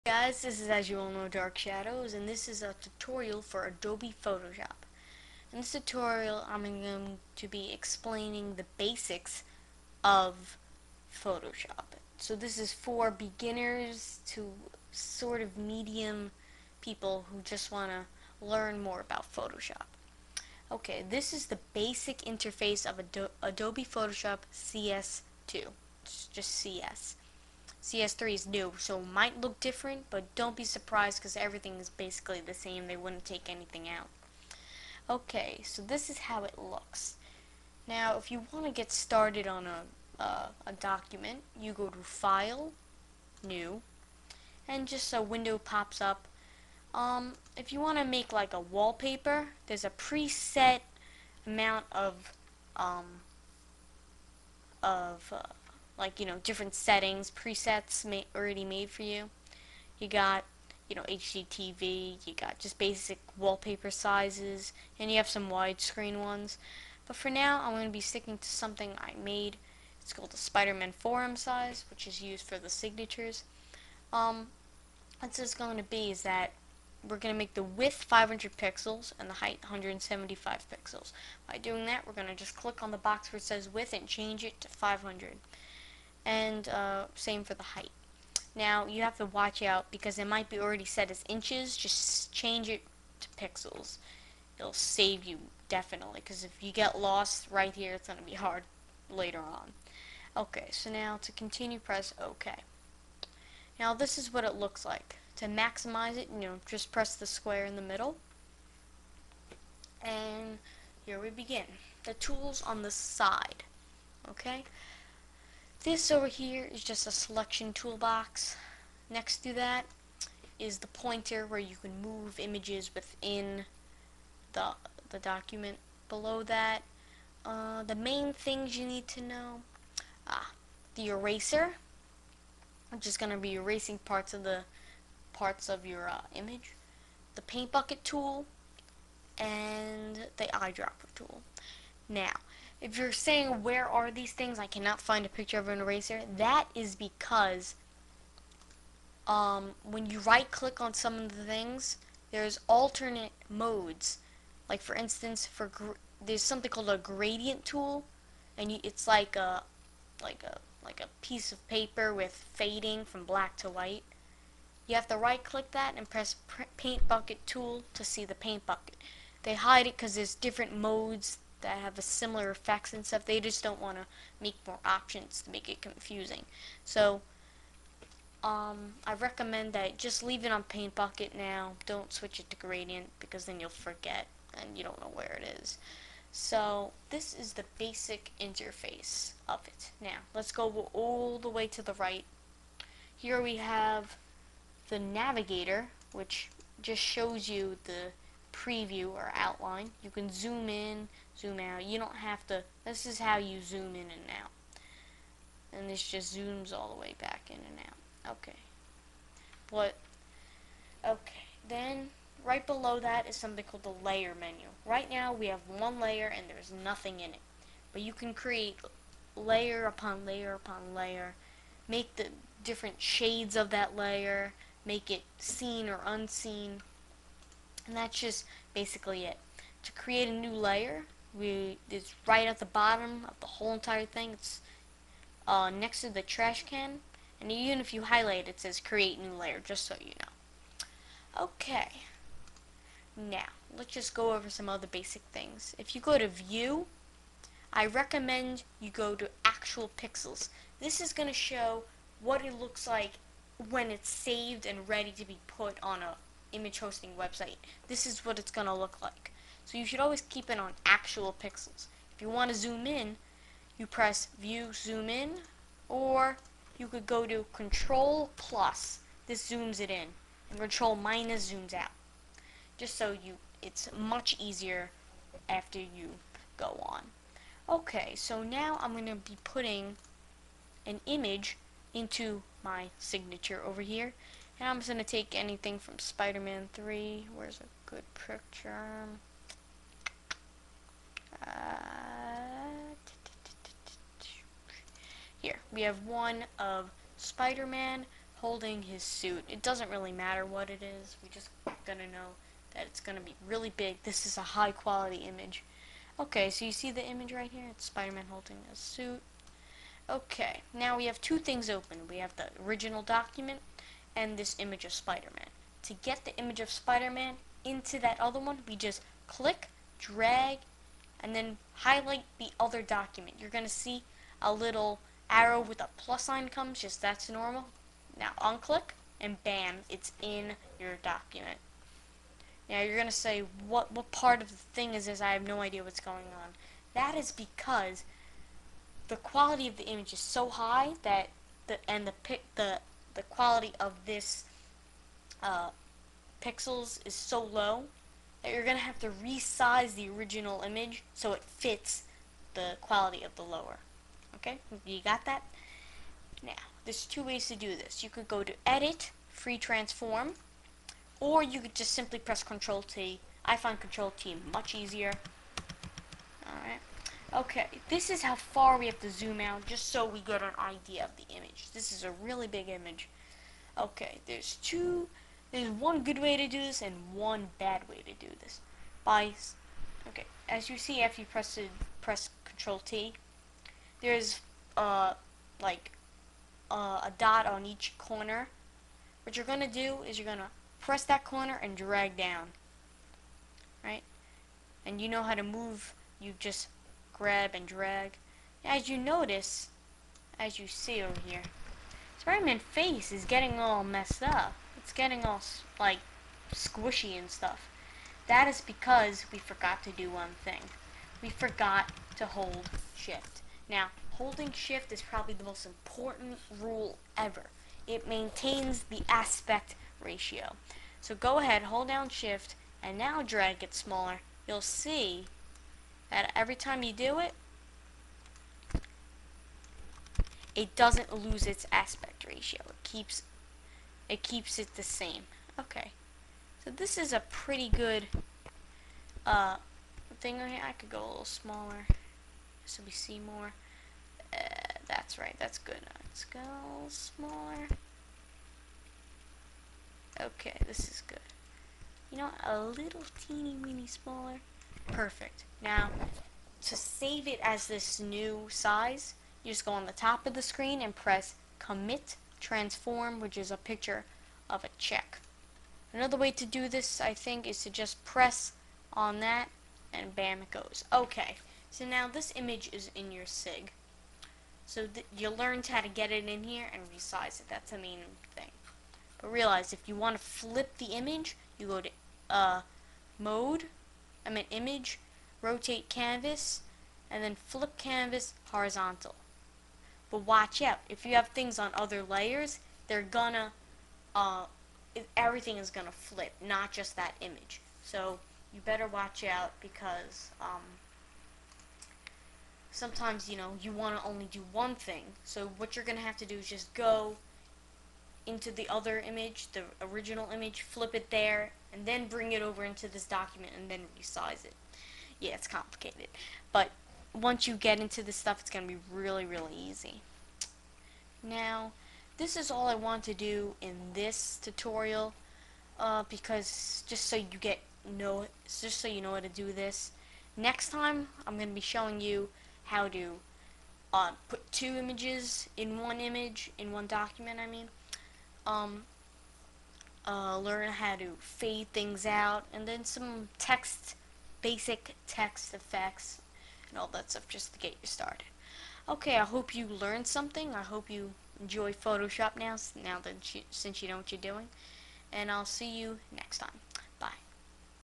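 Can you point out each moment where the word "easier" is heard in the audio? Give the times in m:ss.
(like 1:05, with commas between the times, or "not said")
4:34, 6:04.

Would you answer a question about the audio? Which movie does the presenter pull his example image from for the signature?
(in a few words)
Spider-Man 3.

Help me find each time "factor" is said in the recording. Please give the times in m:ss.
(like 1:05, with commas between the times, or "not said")
not said.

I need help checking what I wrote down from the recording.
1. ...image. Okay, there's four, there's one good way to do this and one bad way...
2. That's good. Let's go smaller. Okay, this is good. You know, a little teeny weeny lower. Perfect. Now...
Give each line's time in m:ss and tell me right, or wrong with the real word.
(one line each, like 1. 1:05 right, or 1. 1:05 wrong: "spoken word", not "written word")
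1. 6:12 wrong: "two", not "four"
2. 7:25 wrong: "smaller", not "lower".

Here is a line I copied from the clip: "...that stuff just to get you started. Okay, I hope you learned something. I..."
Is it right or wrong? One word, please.
right.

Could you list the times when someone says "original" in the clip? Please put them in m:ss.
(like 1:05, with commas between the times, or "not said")
5:12, 5:50, 8:29.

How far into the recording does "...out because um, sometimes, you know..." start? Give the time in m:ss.
8:19.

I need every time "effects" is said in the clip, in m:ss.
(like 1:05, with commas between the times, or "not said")
2:52, 9:05.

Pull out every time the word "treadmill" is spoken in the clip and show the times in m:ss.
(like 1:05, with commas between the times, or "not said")
not said.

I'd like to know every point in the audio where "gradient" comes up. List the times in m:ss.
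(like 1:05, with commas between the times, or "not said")
2:36, 3:02.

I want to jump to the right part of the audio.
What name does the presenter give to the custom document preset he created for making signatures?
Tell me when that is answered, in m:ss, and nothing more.
1:10.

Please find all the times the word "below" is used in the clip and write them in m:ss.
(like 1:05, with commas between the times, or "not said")
2:06, 3:32.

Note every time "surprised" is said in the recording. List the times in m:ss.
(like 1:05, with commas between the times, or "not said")
0:30.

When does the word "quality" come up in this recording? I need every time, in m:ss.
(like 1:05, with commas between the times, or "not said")
5:04, 5:39, 5:43, 5:52.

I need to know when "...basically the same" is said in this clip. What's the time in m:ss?
0:31.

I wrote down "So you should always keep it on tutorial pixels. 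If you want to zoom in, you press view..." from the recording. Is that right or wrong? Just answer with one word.
wrong.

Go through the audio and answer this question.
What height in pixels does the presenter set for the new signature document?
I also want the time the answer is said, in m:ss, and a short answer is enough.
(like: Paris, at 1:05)
175 pixels, at 1:19.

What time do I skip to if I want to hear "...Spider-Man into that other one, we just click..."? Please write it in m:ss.
5:16.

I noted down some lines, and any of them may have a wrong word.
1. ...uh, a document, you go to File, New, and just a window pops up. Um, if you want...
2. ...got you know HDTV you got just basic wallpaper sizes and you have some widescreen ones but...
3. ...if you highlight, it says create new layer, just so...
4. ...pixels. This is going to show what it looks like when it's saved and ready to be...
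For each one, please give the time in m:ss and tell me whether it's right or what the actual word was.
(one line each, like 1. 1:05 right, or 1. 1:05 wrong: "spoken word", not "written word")
1. 0:40 right
2. 1:00 right
3. 3:57 right
4. 4:09 right.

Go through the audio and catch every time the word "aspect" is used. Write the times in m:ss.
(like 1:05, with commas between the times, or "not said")
6:59, 7:11.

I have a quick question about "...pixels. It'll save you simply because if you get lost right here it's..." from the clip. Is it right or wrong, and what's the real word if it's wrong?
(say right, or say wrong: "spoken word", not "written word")
wrong: "definitely", not "simply".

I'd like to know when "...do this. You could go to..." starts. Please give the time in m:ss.
5:57.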